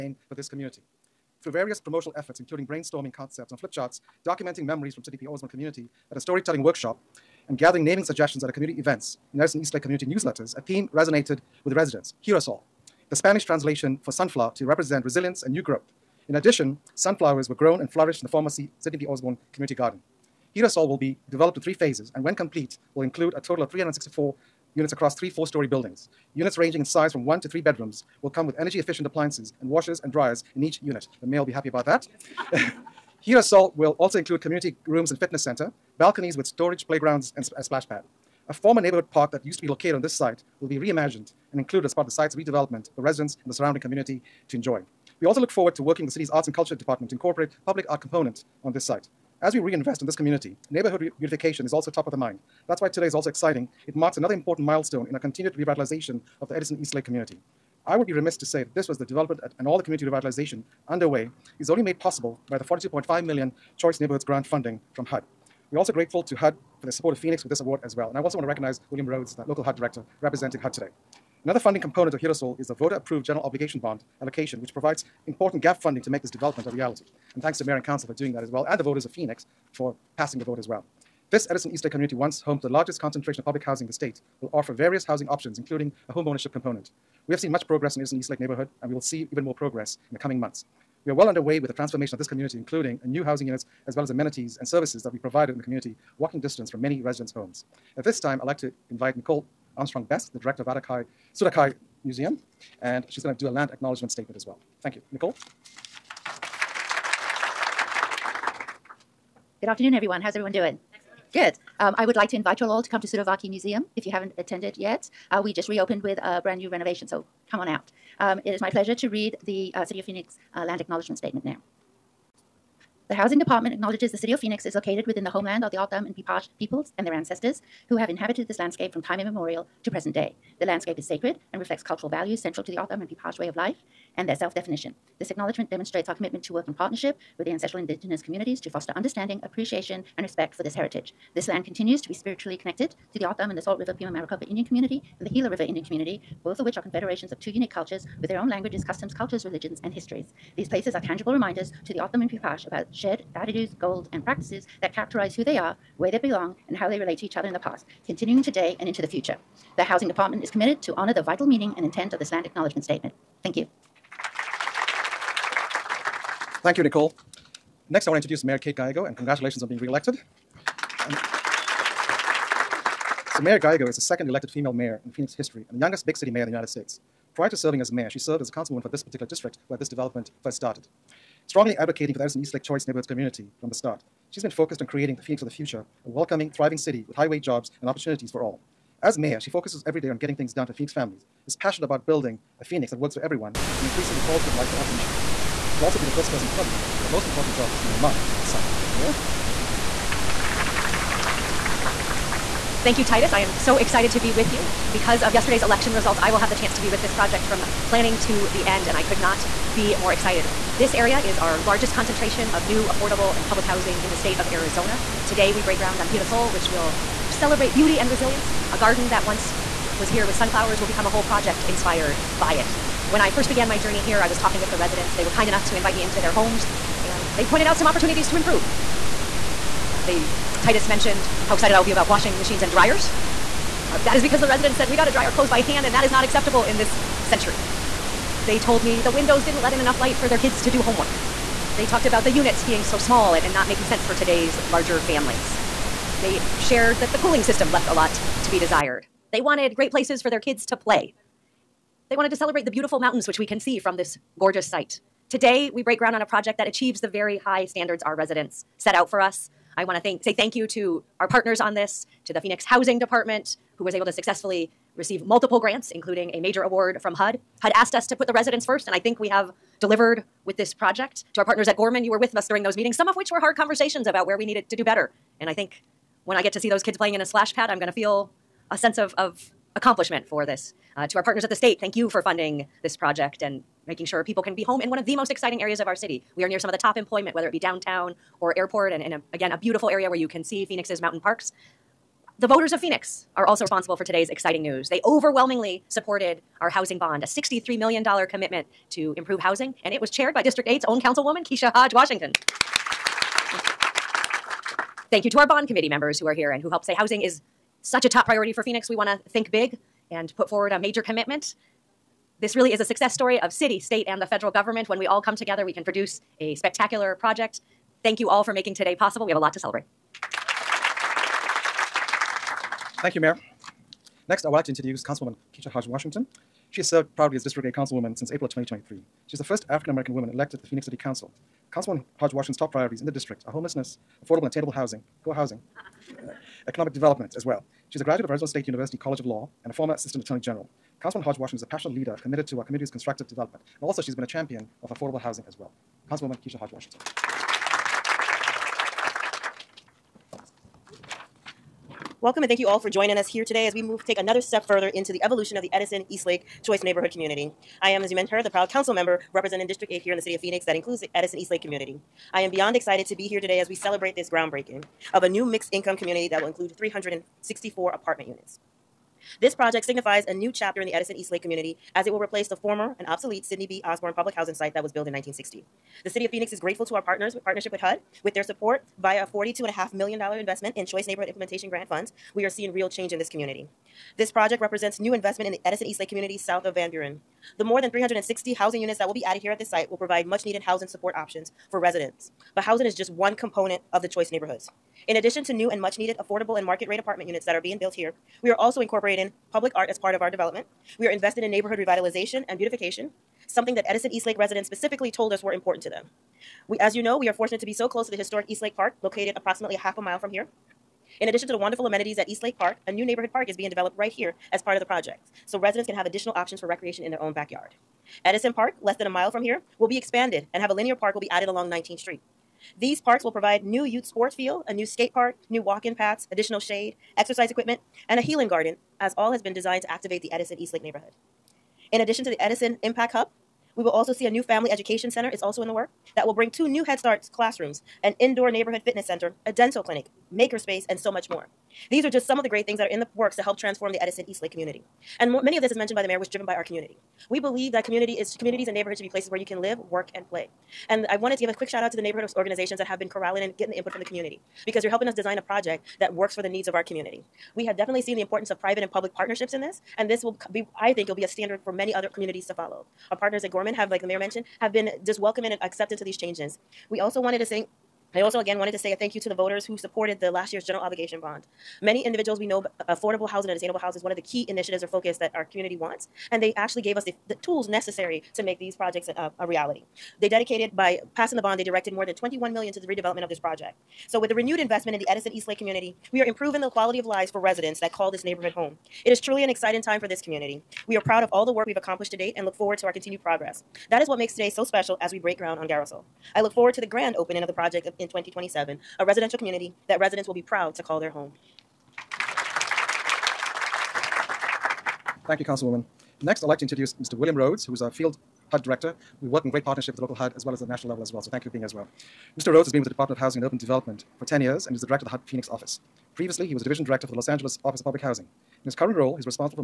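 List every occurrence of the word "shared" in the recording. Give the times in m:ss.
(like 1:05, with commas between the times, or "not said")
2:32, 4:06.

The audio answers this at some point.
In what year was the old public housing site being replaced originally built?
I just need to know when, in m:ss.
6:15.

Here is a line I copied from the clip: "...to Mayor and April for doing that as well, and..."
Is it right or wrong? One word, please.
wrong.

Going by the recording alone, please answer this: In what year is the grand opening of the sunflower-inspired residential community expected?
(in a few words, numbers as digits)
2027.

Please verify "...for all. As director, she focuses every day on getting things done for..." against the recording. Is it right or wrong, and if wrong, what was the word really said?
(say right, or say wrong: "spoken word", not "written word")
wrong: "mayor", not "director".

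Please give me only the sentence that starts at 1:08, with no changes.
And I also want to recognize William Rhodes, the local HUD director, representing HUD today.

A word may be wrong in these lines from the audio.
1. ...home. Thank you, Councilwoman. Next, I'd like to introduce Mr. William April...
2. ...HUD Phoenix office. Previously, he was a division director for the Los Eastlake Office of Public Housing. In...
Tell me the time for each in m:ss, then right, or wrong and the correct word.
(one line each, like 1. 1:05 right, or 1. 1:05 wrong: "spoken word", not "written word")
1. 8:21 wrong: "Rhodes", not "April"
2. 8:35 wrong: "Angeles", not "Eastlake".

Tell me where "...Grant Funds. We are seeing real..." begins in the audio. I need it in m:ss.
6:21.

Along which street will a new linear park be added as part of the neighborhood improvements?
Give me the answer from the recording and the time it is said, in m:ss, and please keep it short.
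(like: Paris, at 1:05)
19th Street, at 7:01.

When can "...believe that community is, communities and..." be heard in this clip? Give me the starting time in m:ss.
7:27.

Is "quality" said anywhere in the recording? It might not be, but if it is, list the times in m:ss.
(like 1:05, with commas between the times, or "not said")
3:14, 8:06.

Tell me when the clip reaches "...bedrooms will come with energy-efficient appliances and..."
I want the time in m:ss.
0:27.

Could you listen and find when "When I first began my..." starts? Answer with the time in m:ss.
3:43.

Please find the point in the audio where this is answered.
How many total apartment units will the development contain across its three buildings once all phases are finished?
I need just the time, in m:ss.
0:23.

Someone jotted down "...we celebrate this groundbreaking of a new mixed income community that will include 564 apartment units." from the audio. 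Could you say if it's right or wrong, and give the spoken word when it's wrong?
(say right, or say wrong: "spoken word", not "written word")
wrong: "364", not "564".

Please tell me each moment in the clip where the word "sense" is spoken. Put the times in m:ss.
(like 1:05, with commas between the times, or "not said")
4:03, 4:38.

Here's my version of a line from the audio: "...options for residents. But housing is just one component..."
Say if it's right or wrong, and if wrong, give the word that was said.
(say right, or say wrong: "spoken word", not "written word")
right.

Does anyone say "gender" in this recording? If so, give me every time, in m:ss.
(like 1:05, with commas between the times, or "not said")
not said.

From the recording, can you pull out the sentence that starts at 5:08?
We want to think big and put forward a major commitment.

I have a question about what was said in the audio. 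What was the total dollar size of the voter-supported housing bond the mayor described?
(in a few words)
$63 million.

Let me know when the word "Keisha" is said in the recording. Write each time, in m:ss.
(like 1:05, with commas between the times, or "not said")
5:01, 5:25, 5:46.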